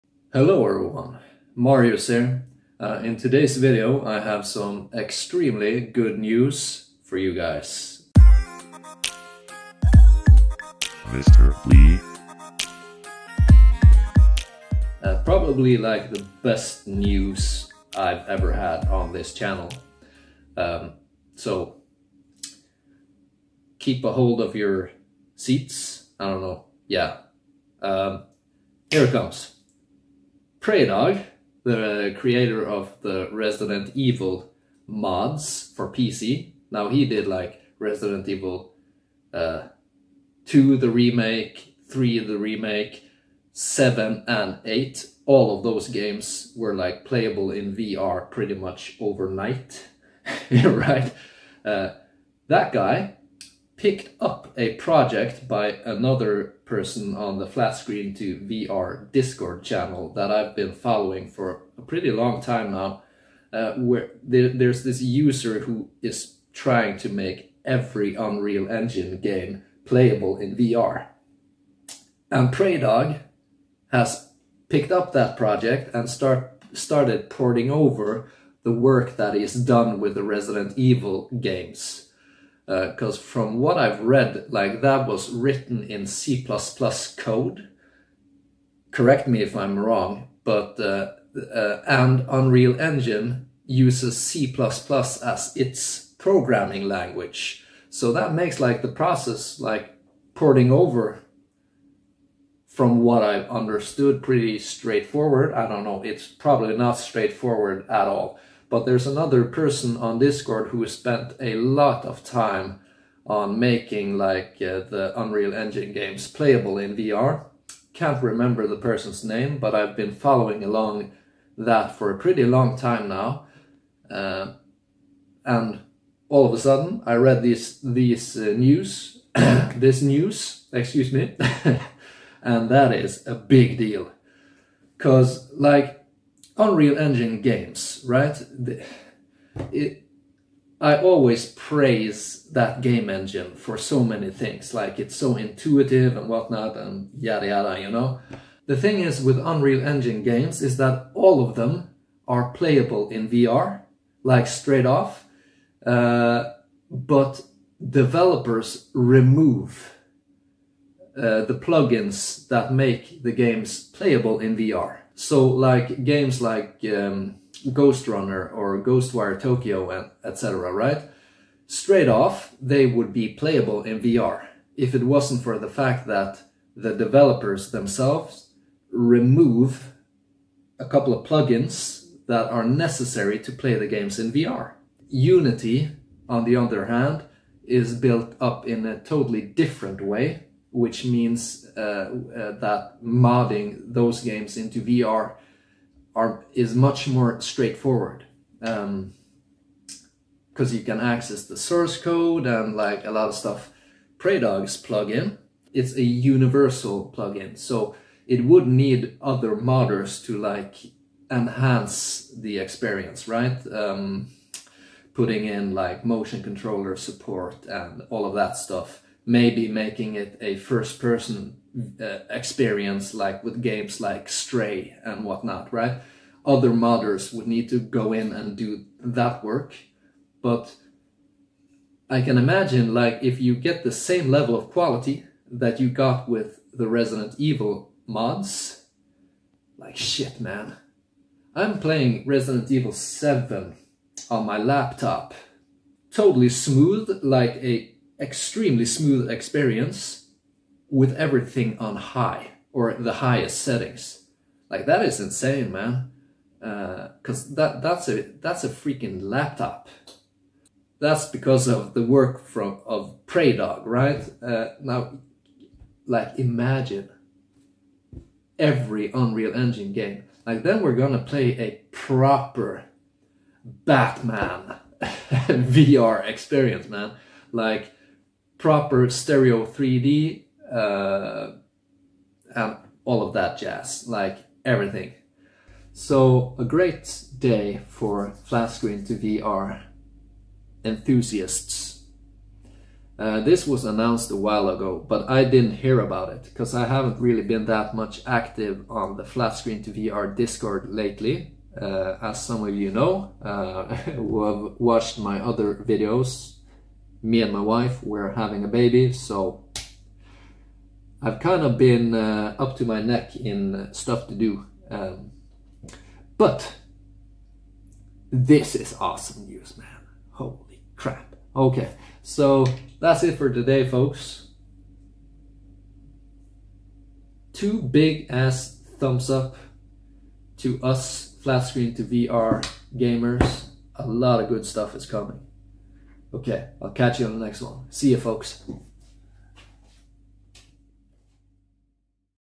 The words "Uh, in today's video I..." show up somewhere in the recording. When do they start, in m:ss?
0:02.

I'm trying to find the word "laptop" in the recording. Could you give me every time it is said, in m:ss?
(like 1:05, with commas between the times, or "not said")
4:04, 4:19.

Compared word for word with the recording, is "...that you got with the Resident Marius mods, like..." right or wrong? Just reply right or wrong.
wrong.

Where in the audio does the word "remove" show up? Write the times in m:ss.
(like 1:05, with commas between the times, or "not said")
2:38, 2:58.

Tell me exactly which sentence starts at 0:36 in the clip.
Now he did like Resident Evil uh, 2, the remake, 3, the remake, 7 and 8.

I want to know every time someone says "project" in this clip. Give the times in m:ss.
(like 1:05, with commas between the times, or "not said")
0:54, 1:15.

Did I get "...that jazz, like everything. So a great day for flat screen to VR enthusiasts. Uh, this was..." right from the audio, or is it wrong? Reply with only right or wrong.
right.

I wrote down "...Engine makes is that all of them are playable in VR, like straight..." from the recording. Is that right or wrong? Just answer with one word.
wrong.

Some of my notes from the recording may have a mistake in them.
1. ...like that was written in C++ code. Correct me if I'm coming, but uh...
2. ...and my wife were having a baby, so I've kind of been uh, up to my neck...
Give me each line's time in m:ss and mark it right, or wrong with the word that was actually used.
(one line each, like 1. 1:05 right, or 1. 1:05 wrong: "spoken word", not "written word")
1. 1:24 wrong: "wrong", not "coming"
2. 5:07 right.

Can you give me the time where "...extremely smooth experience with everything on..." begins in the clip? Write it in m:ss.
4:08.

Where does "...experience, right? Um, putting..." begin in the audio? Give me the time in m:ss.
3:32.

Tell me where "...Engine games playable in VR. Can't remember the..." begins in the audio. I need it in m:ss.
1:55.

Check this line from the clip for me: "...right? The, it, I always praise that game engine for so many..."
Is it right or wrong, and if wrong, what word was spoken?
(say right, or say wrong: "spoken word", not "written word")
right.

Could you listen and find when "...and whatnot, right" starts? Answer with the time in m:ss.
3:45.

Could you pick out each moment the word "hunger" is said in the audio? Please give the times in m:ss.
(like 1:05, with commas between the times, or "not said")
not said.